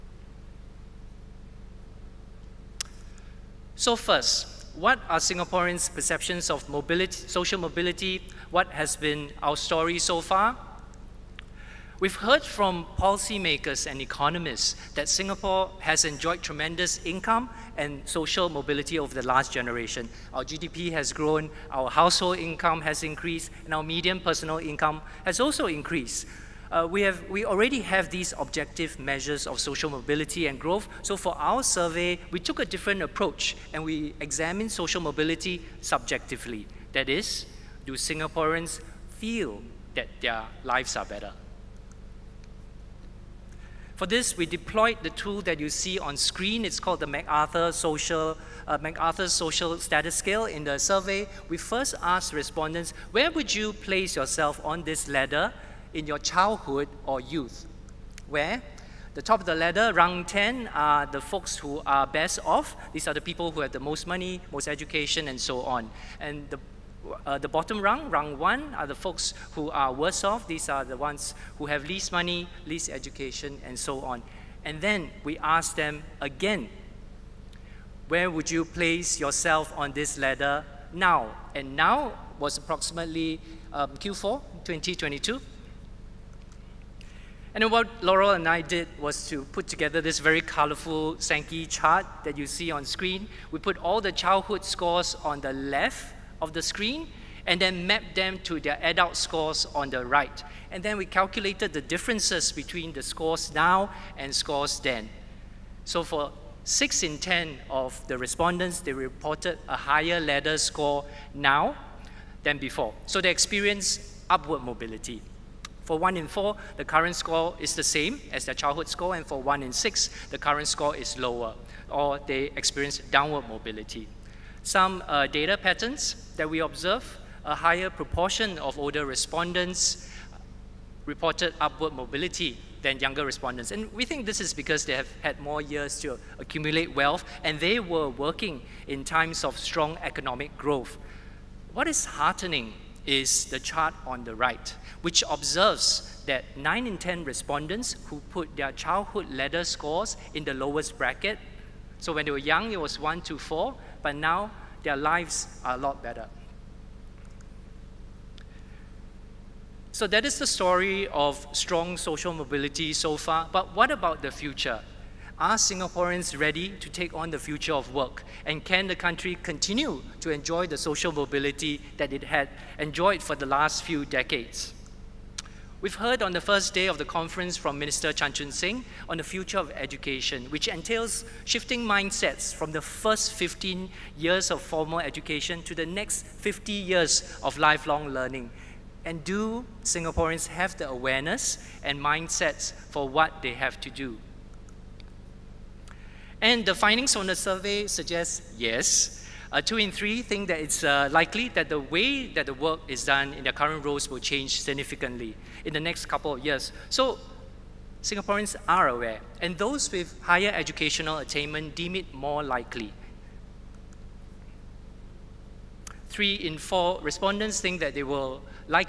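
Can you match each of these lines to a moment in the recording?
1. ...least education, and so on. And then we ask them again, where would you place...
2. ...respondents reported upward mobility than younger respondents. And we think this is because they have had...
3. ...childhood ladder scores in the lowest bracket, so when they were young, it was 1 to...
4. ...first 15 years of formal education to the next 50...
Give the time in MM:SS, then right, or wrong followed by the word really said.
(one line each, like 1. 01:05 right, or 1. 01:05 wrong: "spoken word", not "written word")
1. 01:12 right
2. 02:09 right
3. 02:28 right
4. 03:02 right.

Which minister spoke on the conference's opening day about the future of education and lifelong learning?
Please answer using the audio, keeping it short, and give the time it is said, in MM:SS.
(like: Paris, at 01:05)
Chan Chun Sing, at 02:58.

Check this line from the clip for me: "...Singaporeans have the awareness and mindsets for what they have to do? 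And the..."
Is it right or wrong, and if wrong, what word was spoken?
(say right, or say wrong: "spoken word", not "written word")
right.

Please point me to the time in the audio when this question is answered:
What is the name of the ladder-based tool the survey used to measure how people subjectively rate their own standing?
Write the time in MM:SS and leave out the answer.
00:48.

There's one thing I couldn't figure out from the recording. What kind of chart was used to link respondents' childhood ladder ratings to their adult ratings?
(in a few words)
Sankey chart.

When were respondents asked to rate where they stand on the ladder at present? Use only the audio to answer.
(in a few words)
Q4 2022.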